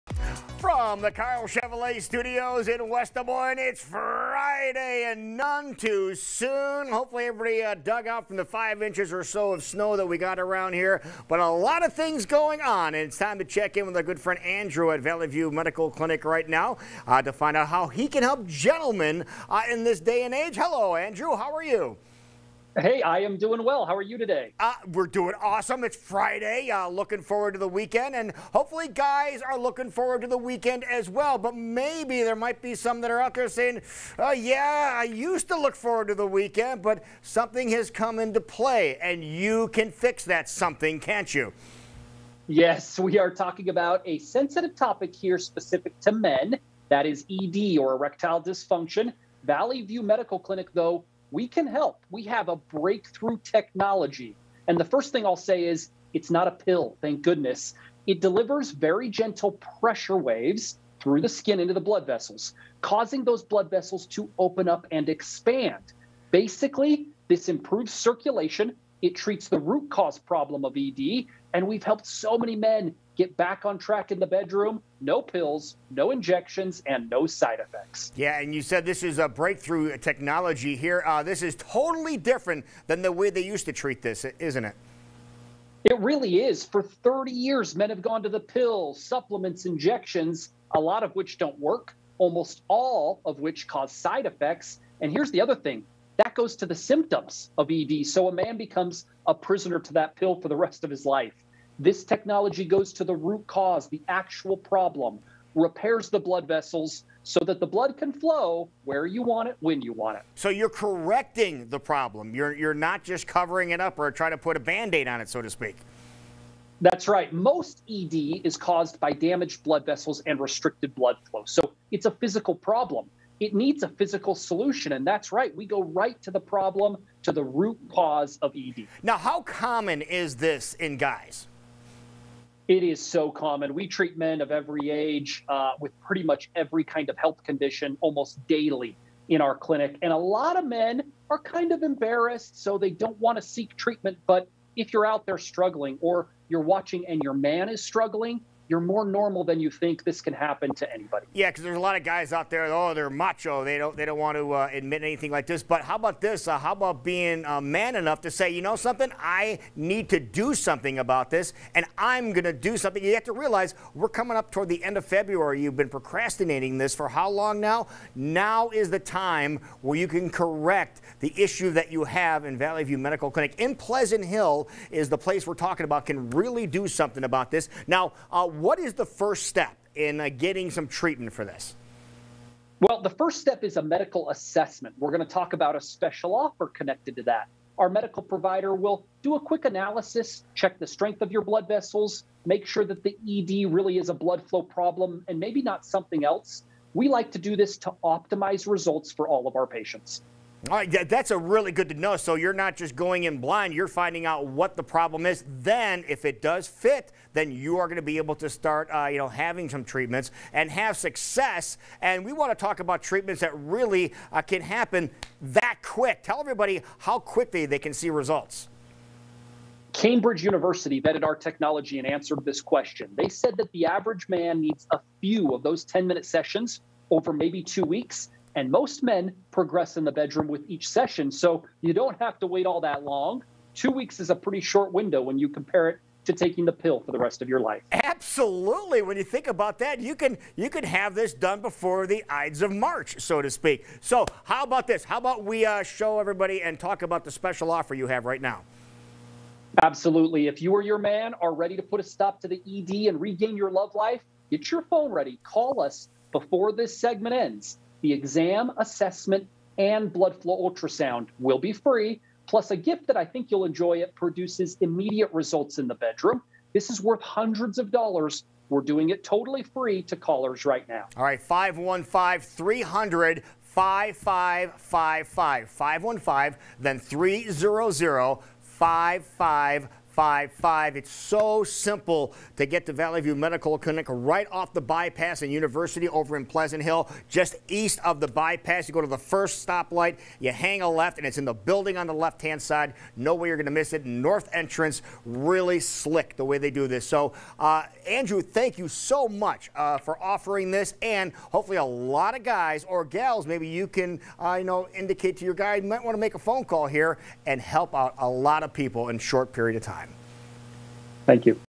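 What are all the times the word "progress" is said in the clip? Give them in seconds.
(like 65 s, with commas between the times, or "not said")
229 s.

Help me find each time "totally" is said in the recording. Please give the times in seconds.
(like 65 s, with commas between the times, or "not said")
81 s, 269 s.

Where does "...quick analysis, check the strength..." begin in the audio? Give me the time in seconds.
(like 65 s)
189 s.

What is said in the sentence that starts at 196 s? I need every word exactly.
We like to do this to optimize results for all of our patients.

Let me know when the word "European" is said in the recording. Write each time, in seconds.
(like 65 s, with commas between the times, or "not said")
not said.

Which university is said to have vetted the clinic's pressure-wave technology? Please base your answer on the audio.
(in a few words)
Cambridge University.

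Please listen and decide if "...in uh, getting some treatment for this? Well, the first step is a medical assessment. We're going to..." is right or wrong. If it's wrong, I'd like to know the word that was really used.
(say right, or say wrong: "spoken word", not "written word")
right.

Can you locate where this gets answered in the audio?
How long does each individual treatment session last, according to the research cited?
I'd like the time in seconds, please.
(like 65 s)
225 s.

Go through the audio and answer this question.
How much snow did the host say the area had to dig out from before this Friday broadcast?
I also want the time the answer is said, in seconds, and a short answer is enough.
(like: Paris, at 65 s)
5 inches, at 8 s.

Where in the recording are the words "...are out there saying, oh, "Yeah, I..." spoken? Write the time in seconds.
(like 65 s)
33 s.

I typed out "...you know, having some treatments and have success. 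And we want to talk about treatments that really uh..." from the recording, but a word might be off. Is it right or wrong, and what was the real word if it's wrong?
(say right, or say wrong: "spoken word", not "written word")
right.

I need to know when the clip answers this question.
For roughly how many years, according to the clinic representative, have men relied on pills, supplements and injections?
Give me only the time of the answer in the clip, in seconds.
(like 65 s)
86 s.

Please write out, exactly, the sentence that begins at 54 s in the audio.
And the first thing I'll say is it's not a pill, thank goodness.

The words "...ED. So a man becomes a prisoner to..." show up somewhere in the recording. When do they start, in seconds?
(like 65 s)
97 s.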